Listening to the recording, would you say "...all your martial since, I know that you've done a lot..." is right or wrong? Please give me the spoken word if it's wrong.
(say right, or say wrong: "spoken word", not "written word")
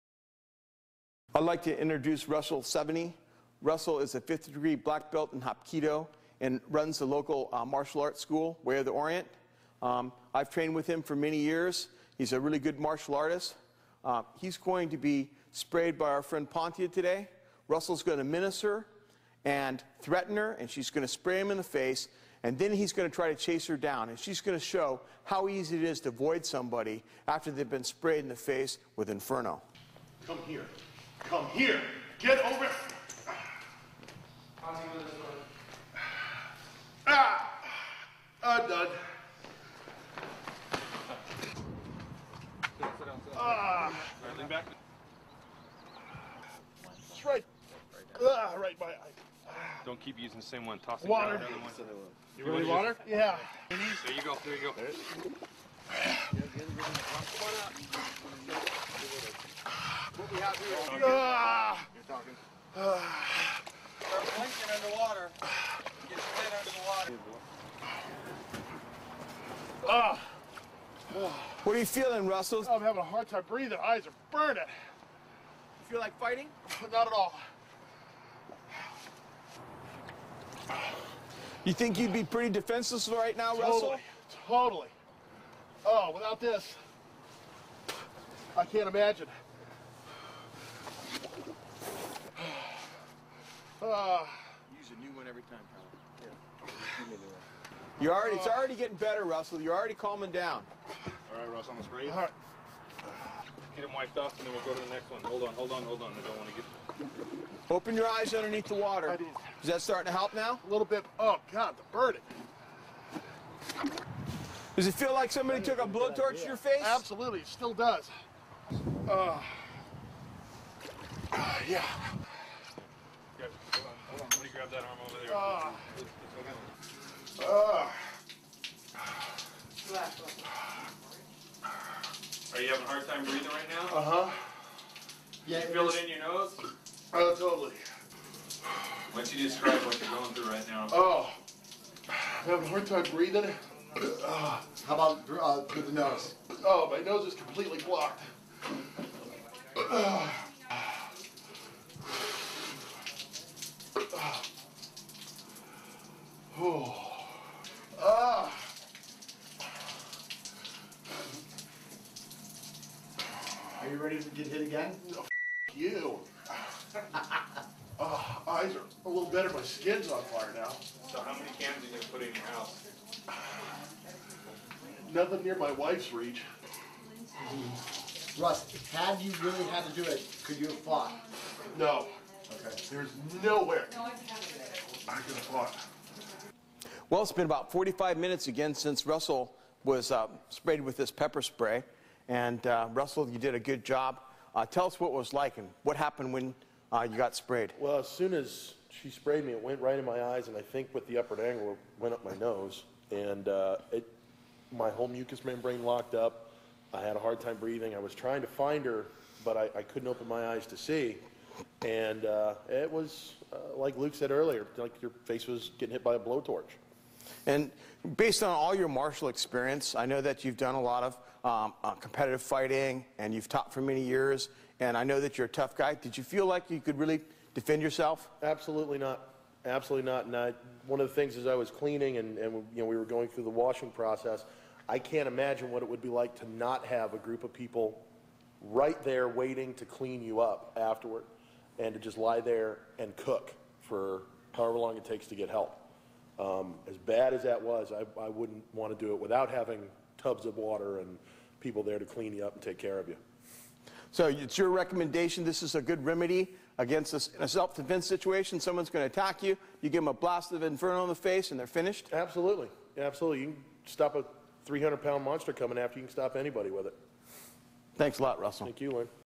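wrong: "experience", not "since".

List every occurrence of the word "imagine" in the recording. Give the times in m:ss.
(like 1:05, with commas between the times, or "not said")
1:28, 3:55.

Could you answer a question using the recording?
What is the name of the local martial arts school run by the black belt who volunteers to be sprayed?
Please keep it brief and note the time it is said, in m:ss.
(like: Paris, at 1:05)
Way of the Orient, at 0:08.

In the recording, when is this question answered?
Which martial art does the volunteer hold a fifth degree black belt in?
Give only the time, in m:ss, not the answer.
0:05.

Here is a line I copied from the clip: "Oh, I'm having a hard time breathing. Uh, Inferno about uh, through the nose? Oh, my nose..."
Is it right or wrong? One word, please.
wrong.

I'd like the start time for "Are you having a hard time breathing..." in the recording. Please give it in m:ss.
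2:12.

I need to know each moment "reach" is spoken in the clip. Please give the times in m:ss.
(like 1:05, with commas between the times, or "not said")
2:56.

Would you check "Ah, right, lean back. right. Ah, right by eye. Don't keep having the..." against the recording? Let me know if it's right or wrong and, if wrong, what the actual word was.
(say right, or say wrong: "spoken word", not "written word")
wrong: "using", not "having".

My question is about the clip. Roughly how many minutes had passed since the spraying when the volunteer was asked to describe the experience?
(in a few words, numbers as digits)
45.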